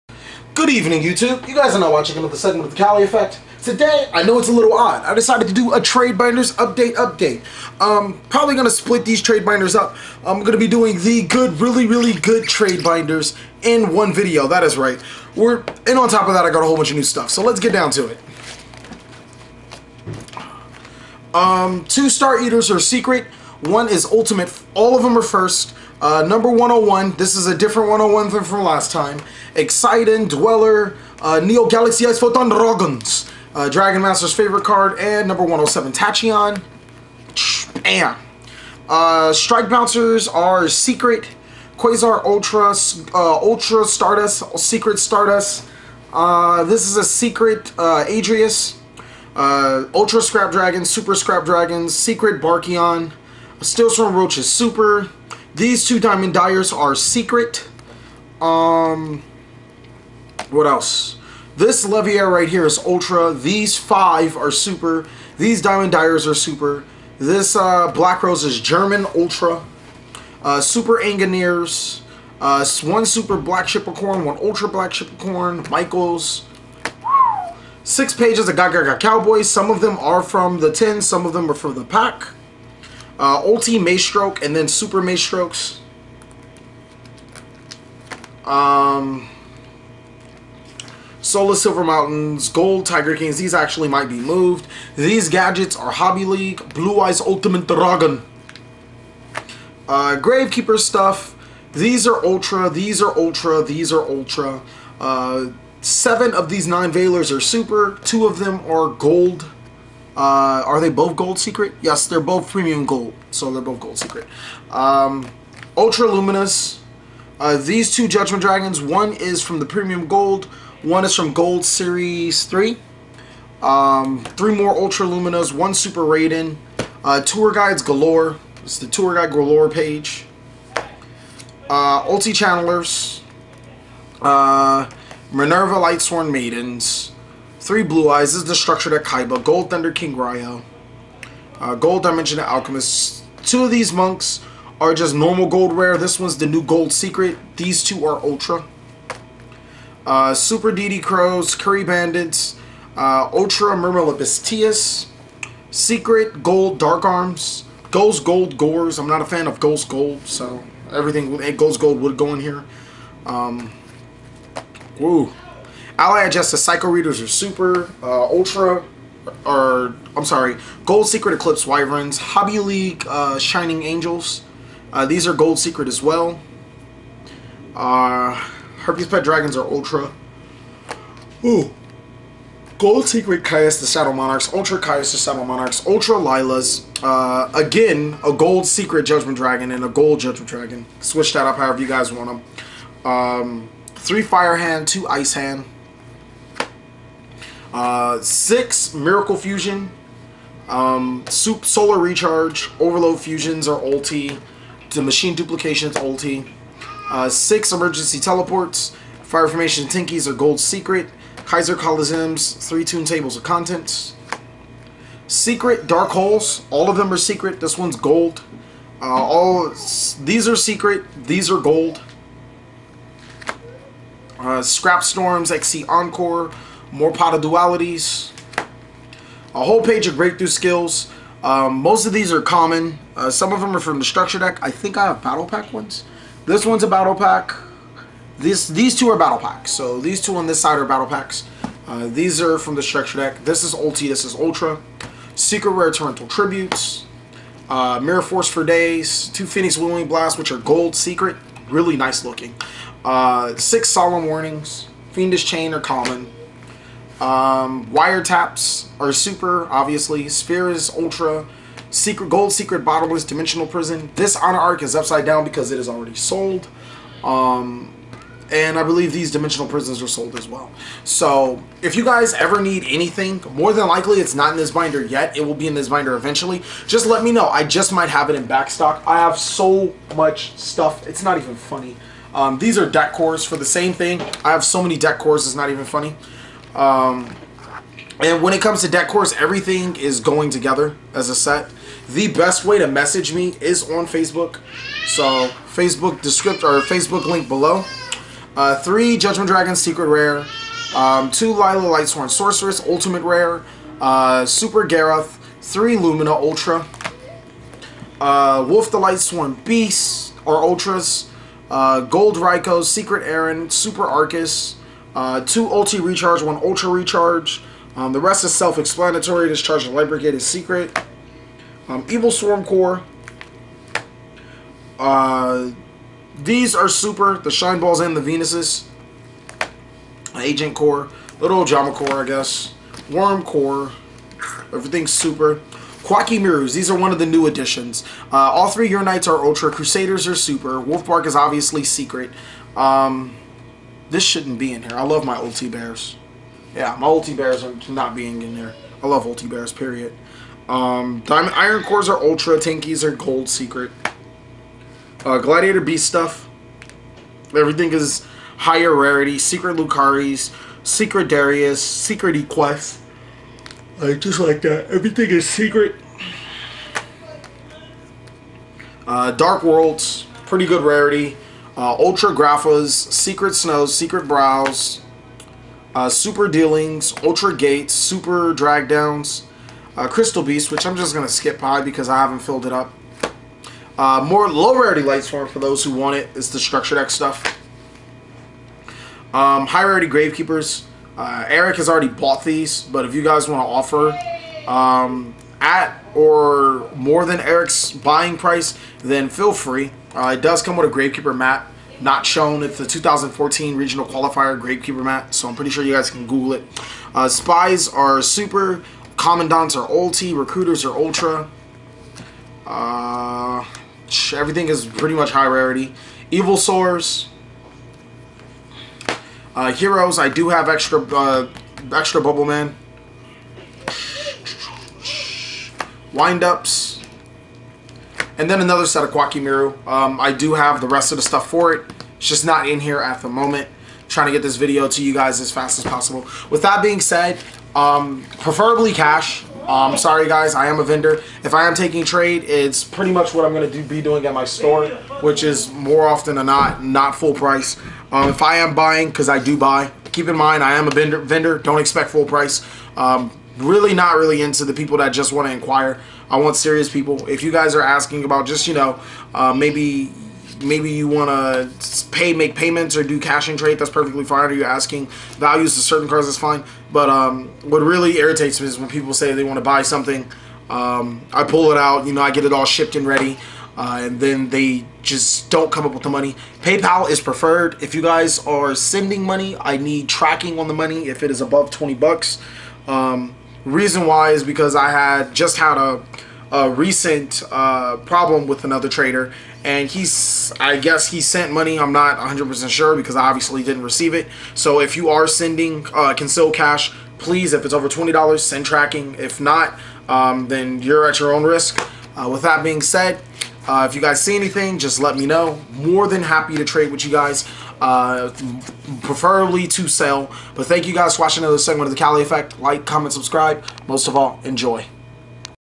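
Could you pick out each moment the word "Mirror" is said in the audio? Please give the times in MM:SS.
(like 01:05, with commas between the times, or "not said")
04:07, 05:36.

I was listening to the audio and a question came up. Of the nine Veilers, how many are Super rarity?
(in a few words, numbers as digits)
7.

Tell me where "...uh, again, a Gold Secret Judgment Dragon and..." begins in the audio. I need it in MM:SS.
03:07.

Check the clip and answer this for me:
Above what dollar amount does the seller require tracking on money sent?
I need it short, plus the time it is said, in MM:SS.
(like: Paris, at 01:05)
$20, at 08:01.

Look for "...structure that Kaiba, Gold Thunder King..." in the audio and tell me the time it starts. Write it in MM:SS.
02:18.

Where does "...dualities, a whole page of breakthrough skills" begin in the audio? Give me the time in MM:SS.
03:47.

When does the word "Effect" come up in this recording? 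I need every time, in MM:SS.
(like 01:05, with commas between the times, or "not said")
00:03, 08:32.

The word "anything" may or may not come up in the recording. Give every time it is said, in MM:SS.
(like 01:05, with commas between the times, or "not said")
04:32, 08:24.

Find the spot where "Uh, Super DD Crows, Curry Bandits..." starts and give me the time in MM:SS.
02:30.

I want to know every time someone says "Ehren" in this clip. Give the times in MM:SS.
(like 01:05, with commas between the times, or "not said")
05:13.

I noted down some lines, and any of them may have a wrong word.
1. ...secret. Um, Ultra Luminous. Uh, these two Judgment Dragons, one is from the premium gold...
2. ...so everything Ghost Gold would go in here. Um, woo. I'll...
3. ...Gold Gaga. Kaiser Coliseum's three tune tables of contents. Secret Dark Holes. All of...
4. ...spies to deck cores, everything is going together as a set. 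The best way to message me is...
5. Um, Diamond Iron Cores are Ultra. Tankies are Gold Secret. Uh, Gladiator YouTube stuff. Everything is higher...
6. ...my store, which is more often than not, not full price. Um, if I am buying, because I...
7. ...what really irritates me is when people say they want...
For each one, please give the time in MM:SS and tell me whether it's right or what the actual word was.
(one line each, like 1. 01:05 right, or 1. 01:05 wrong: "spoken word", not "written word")
1. 01:53 right
2. 02:40 right
3. 03:30 wrong: "Secret", not "Gaga"
4. 04:48 wrong: "comes", not "spies"
5. 05:50 wrong: "Beast", not "YouTube"
6. 07:24 right
7. 07:47 right.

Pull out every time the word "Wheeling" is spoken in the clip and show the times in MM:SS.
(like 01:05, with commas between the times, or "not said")
04:09.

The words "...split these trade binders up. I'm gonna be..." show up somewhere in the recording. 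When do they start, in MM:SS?
00:08.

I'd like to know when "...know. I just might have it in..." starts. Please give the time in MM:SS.
04:37.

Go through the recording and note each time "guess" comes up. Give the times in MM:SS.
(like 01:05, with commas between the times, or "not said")
05:32, 08:10.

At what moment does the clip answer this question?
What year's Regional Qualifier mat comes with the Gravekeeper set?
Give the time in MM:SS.
06:42.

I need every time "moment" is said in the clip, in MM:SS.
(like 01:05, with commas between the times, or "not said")
07:13.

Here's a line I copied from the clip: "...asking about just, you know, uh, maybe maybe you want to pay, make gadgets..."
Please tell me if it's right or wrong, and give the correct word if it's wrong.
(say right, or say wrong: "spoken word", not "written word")
wrong: "payments", not "gadgets".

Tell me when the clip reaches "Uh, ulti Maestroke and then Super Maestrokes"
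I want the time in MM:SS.
01:23.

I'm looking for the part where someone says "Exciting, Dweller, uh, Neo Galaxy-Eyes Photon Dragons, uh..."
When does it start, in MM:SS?
00:29.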